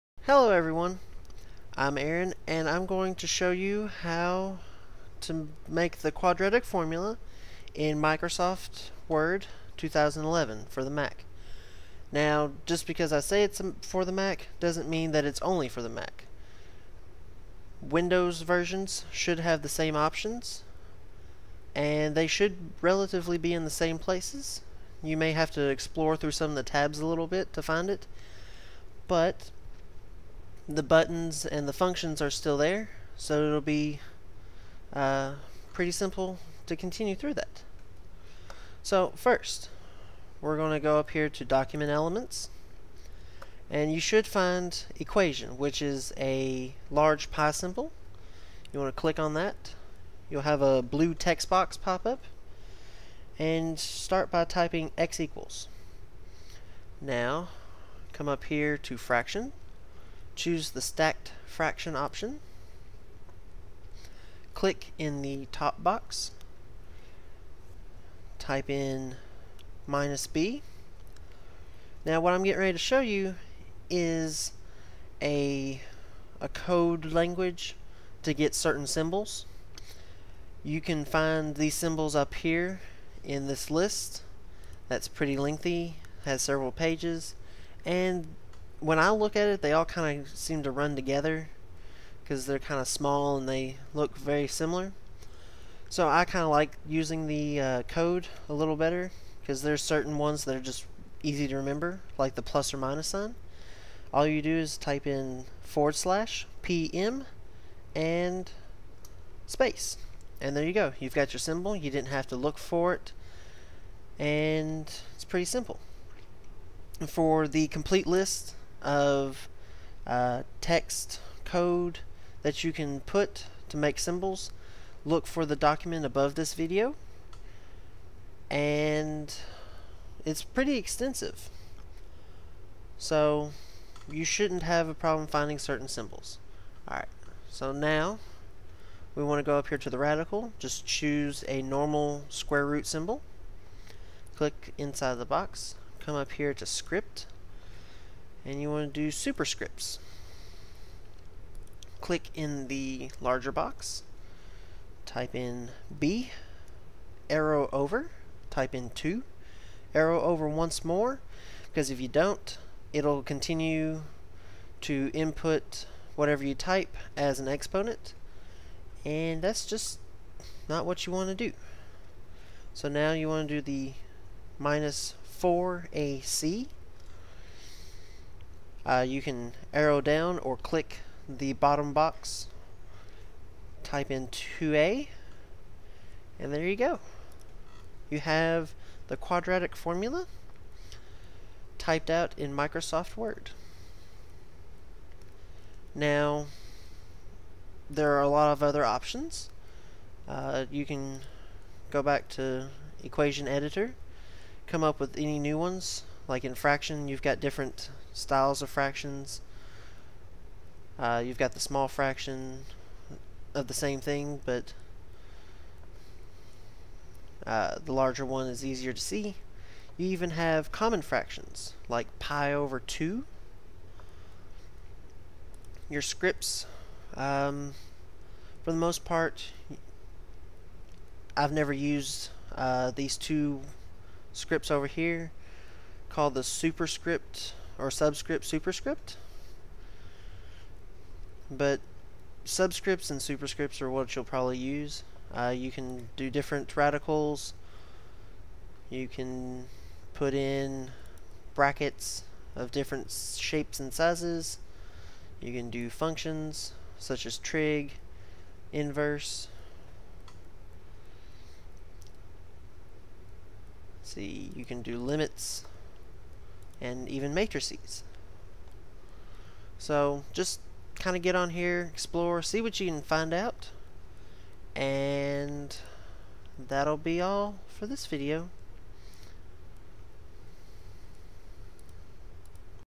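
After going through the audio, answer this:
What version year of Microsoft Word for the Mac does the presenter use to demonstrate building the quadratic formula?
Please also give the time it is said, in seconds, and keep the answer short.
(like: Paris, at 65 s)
2011, at 9 s.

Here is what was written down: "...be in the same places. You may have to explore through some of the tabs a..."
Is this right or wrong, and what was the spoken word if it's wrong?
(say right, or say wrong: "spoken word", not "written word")
right.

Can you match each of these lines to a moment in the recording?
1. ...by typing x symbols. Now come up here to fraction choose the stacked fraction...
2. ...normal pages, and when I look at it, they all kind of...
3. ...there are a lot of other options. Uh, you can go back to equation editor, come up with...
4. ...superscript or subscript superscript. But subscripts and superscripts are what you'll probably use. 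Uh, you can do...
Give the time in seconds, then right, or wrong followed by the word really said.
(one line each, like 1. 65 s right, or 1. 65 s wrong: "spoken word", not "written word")
1. 54 s wrong: "equals", not "symbols"
2. 86 s wrong: "several", not "normal"
3. 197 s right
4. 236 s right.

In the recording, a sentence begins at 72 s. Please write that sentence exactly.
Now what I'm getting ready to show you is a, a code language to get certain symbols.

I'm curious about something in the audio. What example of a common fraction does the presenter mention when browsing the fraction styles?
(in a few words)
pi over 2.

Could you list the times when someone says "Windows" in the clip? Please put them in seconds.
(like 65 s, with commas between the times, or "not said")
17 s.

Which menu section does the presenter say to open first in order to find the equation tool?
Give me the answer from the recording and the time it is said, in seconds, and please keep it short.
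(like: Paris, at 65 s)
document elements, at 41 s.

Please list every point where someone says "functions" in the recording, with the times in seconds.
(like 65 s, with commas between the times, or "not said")
31 s, 255 s.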